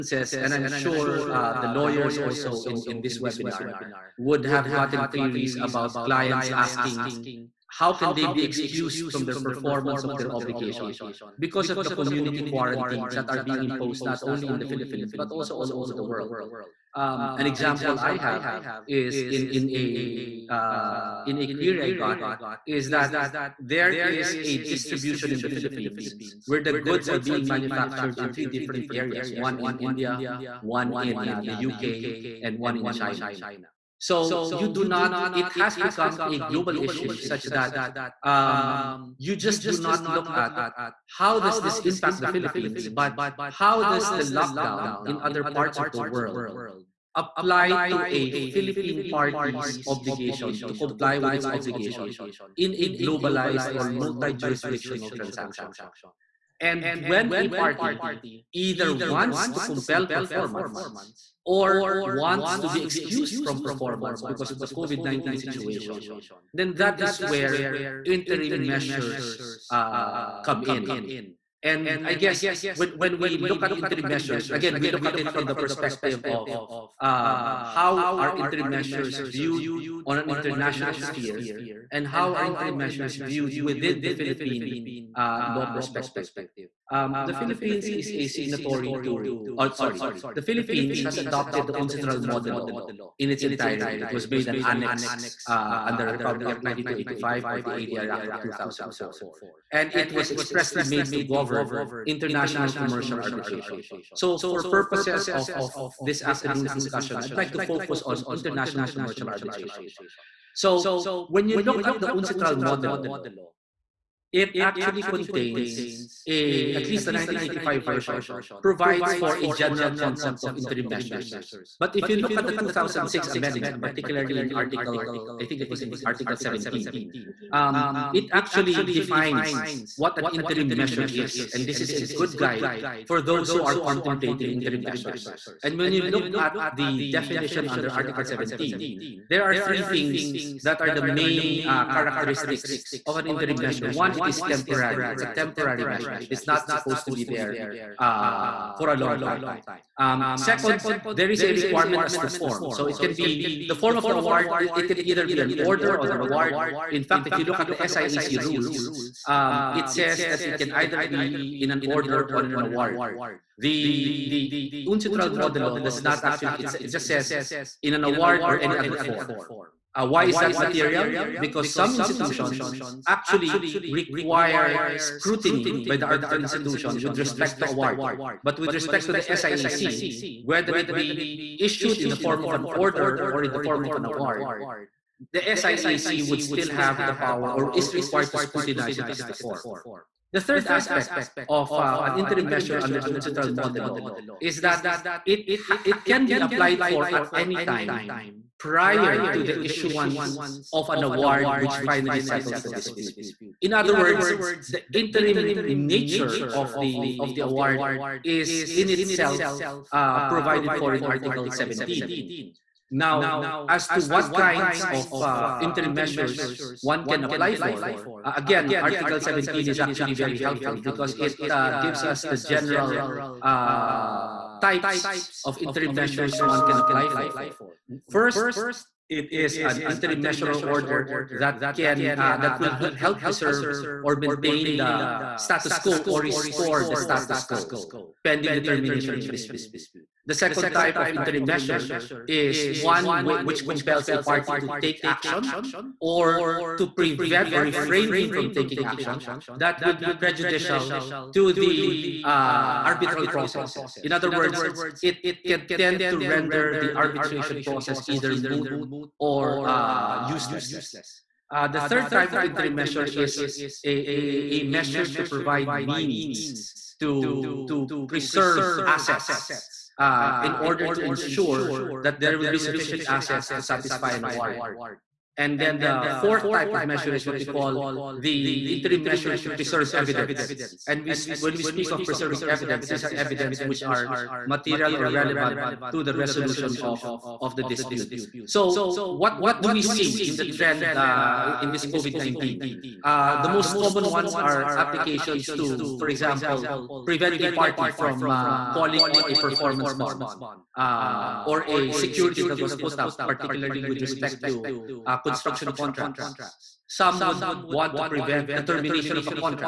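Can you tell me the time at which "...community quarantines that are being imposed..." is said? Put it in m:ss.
0:11.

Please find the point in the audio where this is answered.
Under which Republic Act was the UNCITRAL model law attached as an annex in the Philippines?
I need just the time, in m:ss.
1:36.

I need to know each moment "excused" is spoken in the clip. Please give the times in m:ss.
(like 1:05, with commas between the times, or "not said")
0:08, 1:02.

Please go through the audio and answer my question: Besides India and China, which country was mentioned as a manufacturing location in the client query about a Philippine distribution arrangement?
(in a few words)
UK.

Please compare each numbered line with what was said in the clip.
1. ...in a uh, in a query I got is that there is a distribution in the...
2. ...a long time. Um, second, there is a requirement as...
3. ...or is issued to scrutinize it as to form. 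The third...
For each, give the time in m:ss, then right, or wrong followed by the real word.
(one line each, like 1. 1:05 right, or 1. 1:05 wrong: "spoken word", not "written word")
1. 0:19 right
2. 2:28 right
3. 3:07 wrong: "required", not "issued".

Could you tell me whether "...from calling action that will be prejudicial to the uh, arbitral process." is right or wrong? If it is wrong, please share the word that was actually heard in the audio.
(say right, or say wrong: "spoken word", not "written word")
wrong: "taking", not "calling".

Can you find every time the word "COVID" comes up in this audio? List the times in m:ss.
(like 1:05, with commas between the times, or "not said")
1:04, 4:51.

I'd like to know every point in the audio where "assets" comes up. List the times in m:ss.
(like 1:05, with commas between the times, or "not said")
4:28, 4:33.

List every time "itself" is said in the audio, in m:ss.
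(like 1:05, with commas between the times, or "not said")
3:28.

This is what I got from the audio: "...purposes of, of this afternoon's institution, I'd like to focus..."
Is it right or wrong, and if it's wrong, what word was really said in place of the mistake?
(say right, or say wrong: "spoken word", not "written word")
wrong: "discussion", not "institution".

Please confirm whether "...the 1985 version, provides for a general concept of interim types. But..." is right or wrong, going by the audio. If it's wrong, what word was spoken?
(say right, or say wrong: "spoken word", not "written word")
wrong: "measures", not "types".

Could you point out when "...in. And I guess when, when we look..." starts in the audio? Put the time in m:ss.
1:10.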